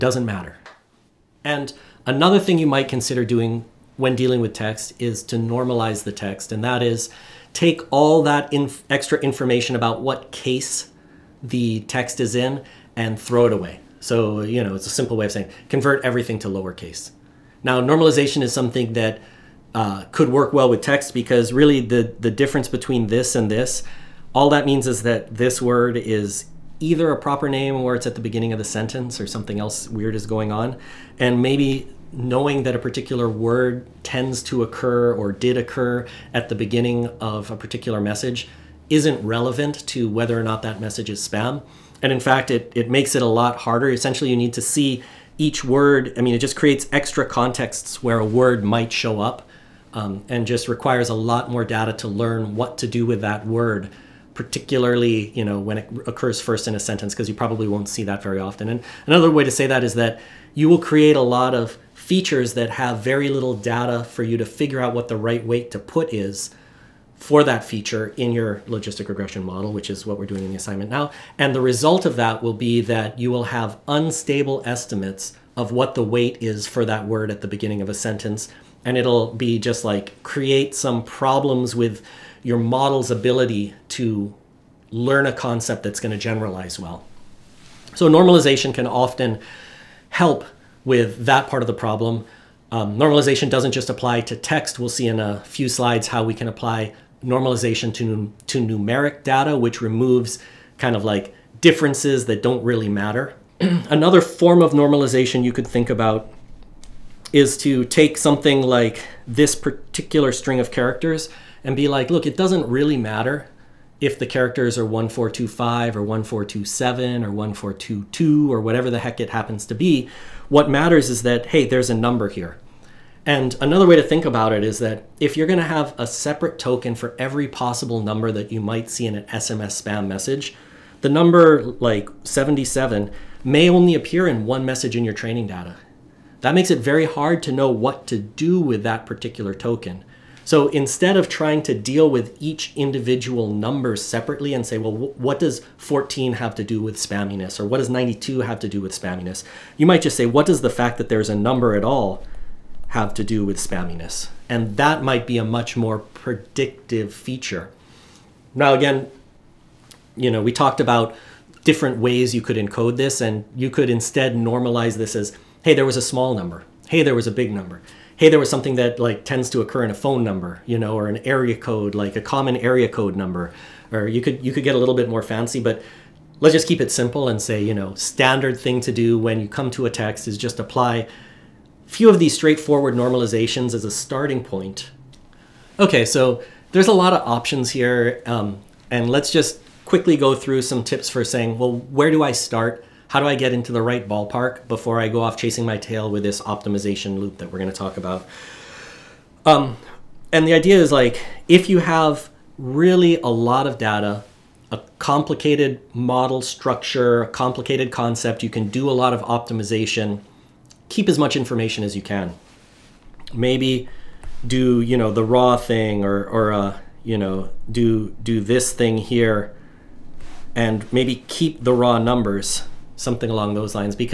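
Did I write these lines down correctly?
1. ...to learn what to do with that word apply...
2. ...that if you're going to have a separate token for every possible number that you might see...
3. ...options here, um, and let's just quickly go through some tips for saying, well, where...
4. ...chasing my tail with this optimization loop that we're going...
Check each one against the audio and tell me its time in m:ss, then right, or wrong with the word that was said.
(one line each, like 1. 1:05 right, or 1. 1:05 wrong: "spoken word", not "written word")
1. 0:51 wrong: "particularly", not "apply"
2. 2:04 right
3. 3:07 right
4. 3:15 right.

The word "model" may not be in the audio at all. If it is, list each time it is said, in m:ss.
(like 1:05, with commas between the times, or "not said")
1:09, 1:22, 3:25.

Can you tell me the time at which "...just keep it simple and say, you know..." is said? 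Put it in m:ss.
2:56.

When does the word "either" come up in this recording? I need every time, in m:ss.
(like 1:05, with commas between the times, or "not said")
0:26.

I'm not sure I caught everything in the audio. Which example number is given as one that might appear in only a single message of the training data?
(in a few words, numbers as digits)
77.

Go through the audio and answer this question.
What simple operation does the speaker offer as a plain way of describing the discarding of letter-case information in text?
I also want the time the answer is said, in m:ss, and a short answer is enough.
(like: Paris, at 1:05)
convert everything to lowercase, at 0:15.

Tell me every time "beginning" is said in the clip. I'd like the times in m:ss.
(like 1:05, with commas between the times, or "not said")
0:28, 0:36, 1:17.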